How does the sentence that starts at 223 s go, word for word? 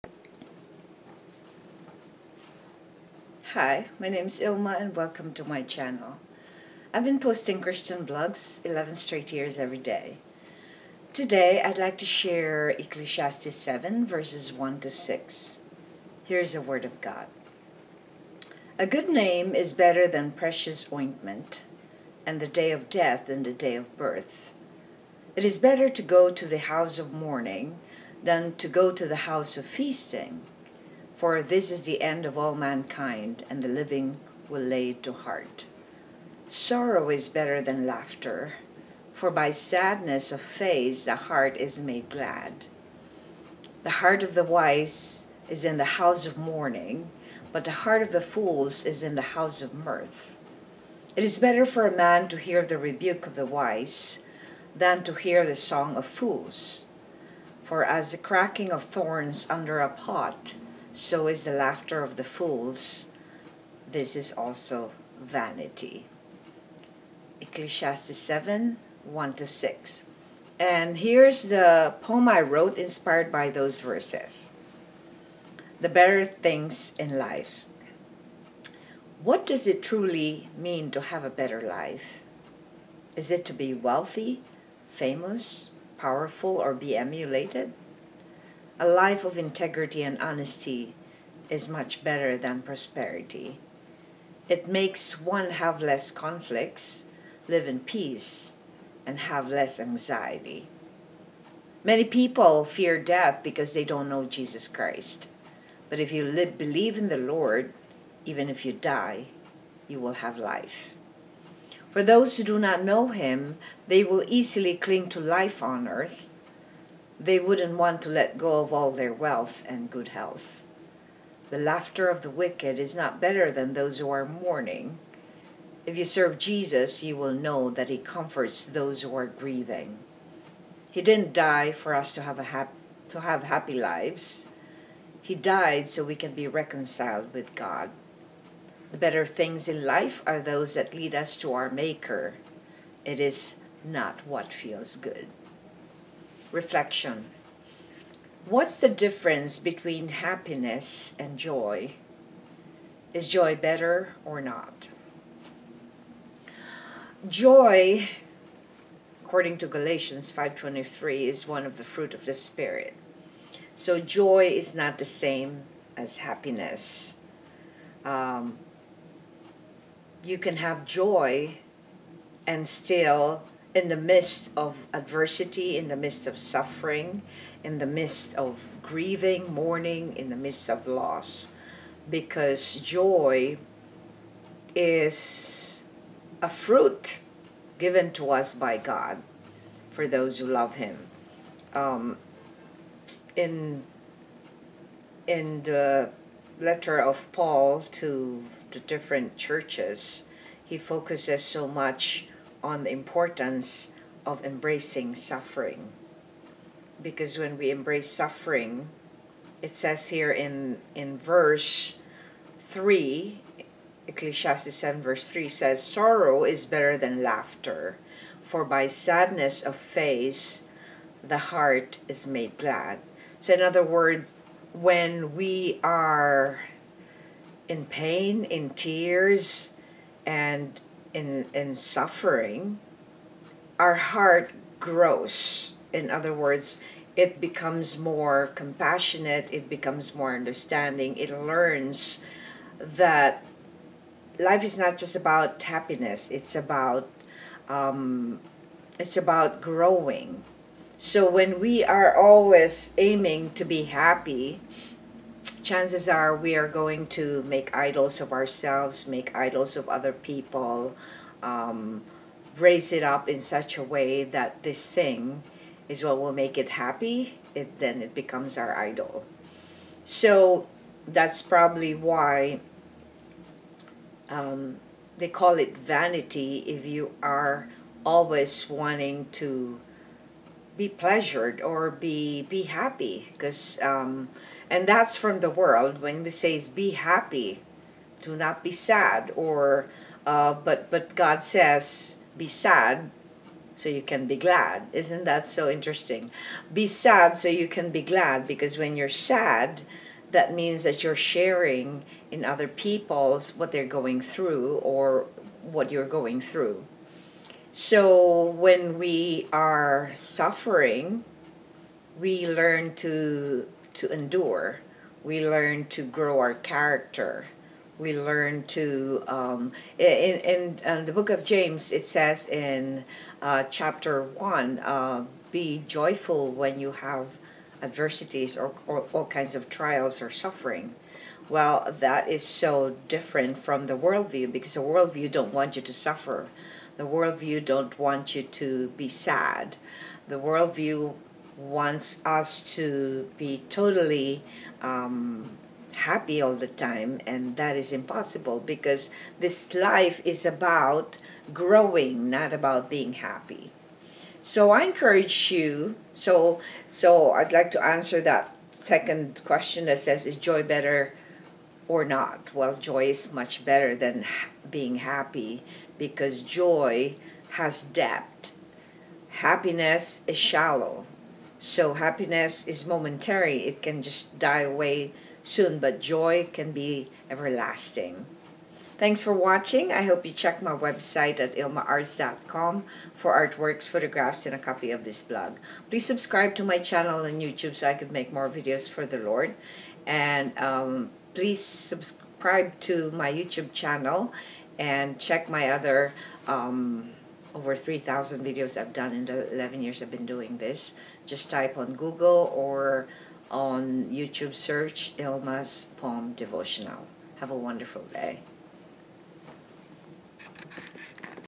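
So in other words, when we are in pain, in tears, and in in suffering, our heart grows.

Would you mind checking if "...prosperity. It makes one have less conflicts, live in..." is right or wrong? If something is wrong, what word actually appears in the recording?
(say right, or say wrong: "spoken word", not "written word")
right.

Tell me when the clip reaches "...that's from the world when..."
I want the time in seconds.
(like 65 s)
284 s.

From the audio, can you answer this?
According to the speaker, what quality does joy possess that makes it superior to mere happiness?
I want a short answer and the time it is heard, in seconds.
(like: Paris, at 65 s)
Depth, at 367 s.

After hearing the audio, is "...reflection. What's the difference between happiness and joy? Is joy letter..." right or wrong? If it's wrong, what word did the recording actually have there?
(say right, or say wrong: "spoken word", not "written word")
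wrong: "better", not "letter".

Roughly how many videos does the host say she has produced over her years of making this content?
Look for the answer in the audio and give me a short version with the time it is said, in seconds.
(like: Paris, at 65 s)
Over 3,000, at 397 s.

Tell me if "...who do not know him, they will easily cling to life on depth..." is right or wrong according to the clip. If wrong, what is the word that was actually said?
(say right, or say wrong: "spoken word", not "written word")
wrong: "earth", not "depth".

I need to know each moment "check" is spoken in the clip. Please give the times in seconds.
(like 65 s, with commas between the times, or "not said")
380 s, 395 s.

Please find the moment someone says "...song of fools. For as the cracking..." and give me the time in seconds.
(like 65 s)
55 s.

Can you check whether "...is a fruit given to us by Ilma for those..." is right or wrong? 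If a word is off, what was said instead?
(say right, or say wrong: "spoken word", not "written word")
wrong: "God", not "Ilma".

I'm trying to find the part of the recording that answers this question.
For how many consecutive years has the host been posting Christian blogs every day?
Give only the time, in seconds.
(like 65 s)
8 s.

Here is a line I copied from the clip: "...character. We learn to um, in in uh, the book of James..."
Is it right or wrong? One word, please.
right.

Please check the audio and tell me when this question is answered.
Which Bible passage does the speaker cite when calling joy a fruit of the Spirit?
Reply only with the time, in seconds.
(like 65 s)
159 s.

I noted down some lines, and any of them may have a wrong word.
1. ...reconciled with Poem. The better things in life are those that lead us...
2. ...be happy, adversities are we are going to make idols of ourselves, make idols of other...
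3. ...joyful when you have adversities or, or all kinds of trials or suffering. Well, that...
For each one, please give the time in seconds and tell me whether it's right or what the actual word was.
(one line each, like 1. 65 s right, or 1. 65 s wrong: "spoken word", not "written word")
1. 136 s wrong: "God", not "Poem"
2. 253 s wrong: "chances", not "adversities"
3. 325 s right.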